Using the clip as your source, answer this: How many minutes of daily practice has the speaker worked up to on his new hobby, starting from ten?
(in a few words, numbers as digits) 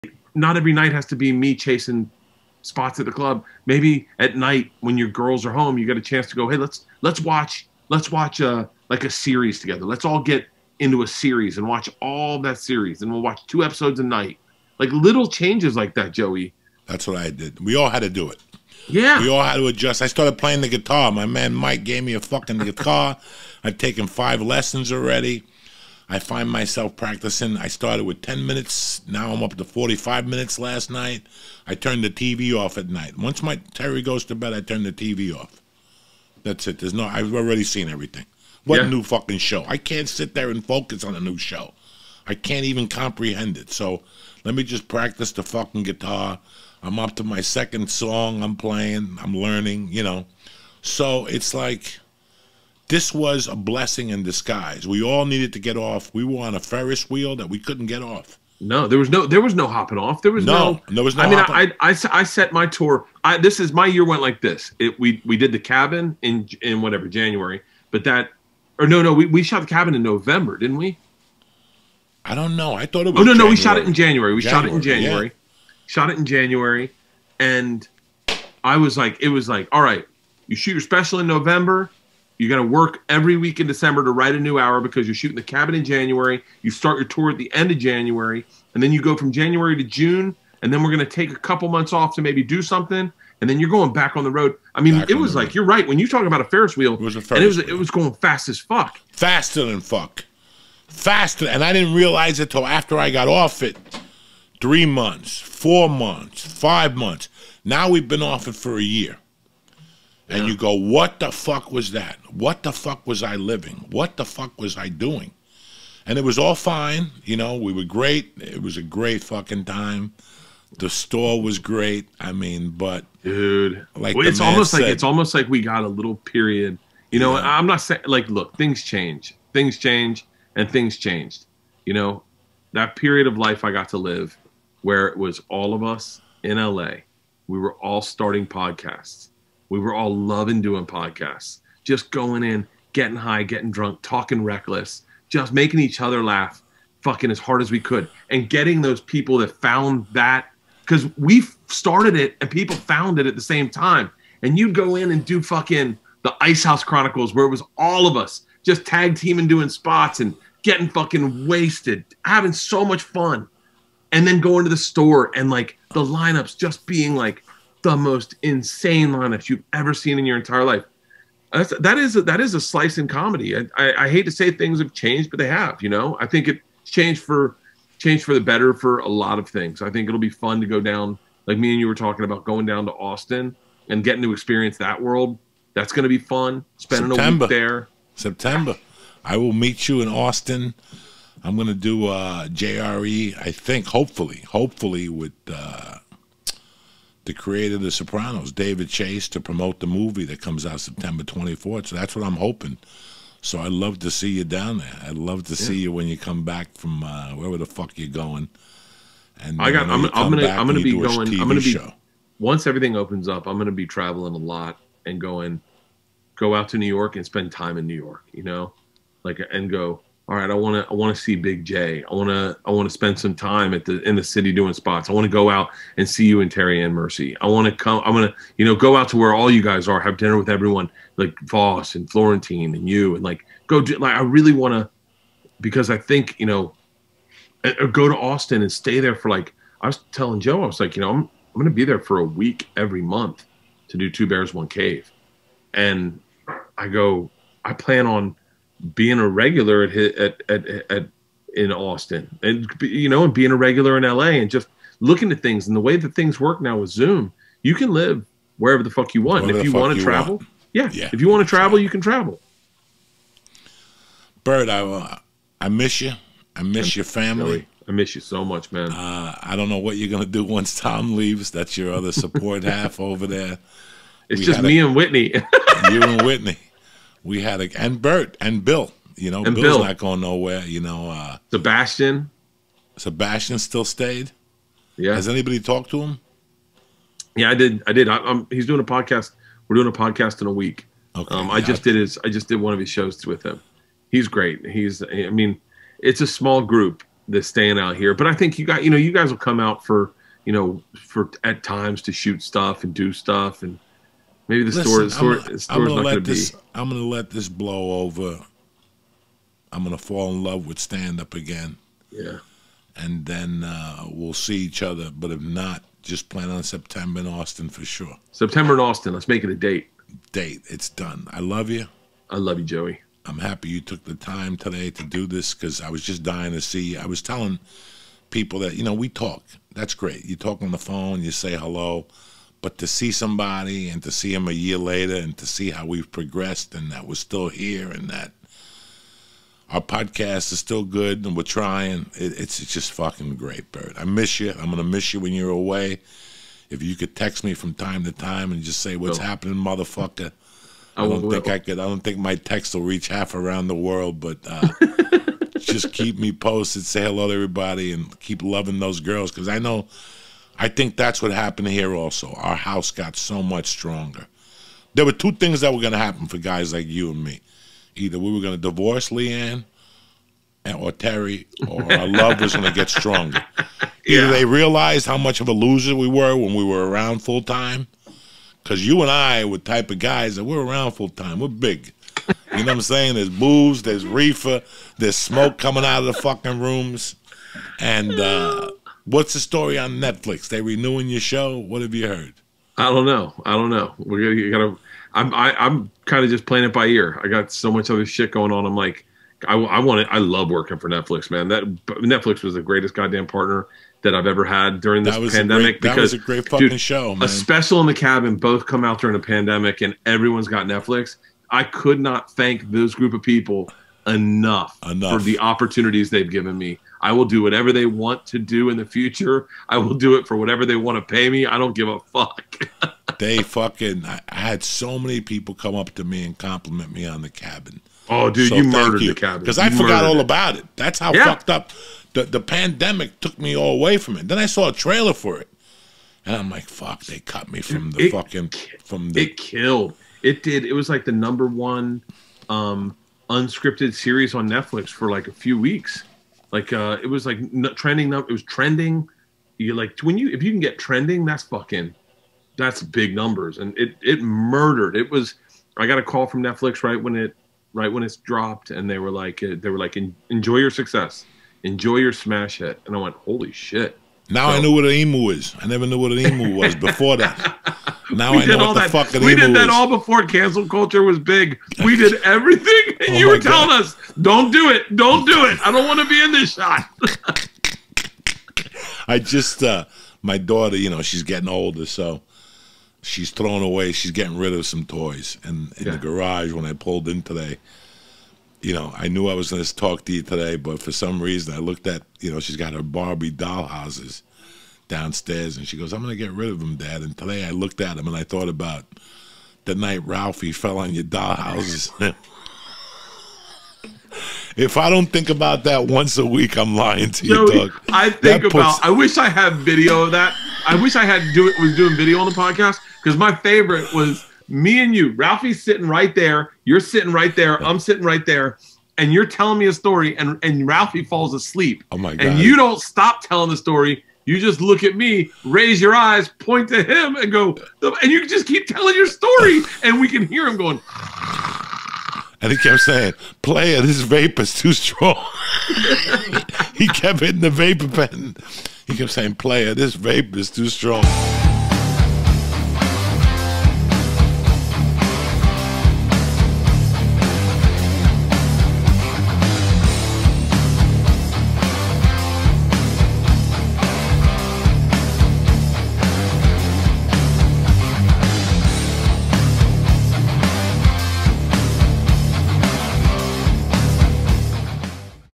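45.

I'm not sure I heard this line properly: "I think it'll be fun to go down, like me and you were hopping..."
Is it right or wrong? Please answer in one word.
wrong.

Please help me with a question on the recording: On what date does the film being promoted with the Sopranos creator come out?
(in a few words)
September 24.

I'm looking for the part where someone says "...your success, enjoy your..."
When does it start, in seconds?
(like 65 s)
460 s.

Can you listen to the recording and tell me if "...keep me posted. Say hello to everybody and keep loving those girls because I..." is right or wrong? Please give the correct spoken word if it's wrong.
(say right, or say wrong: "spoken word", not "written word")
right.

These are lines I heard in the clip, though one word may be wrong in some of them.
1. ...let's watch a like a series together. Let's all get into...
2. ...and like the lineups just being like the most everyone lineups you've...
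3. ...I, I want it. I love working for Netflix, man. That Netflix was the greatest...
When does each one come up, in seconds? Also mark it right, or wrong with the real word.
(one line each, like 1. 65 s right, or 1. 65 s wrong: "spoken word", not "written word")
1. 7 s right
2. 165 s wrong: "insane", not "everyone"
3. 399 s right.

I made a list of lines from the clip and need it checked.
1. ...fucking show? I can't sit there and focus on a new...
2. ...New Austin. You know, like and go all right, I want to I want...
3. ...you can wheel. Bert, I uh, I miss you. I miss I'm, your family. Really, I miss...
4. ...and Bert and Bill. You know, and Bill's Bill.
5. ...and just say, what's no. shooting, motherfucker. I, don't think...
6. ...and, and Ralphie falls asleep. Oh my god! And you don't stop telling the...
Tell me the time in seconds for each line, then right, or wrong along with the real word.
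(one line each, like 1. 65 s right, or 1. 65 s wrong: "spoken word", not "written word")
1. 39 s right
2. 217 s wrong: "York", not "Austin"
3. 261 s wrong: "travel", not "wheel"
4. 277 s right
5. 348 s wrong: "happening", not "shooting"
6. 520 s right.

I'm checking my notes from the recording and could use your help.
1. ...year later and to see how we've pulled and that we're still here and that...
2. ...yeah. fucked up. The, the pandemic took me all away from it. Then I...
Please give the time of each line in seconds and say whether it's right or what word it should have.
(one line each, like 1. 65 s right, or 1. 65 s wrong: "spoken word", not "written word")
1. 334 s wrong: "progressed", not "pulled"
2. 431 s right.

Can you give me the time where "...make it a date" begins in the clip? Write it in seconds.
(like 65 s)
319 s.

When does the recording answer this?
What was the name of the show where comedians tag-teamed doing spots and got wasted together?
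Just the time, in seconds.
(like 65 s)
156 s.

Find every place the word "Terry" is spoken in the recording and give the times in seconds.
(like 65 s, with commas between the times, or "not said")
33 s, 226 s, 370 s.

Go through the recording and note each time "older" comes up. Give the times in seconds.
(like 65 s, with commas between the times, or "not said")
481 s.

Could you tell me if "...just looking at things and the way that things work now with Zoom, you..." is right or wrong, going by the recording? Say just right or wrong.
right.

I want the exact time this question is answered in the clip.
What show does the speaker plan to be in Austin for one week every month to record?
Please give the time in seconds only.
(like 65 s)
244 s.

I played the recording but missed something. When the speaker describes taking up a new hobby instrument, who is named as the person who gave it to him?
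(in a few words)
Mike.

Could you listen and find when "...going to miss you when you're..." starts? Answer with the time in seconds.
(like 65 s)
344 s.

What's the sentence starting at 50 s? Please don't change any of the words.
So it's like this was a blessing in disguise.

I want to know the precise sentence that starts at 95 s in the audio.
you're right when you talk about a Ferris wheel.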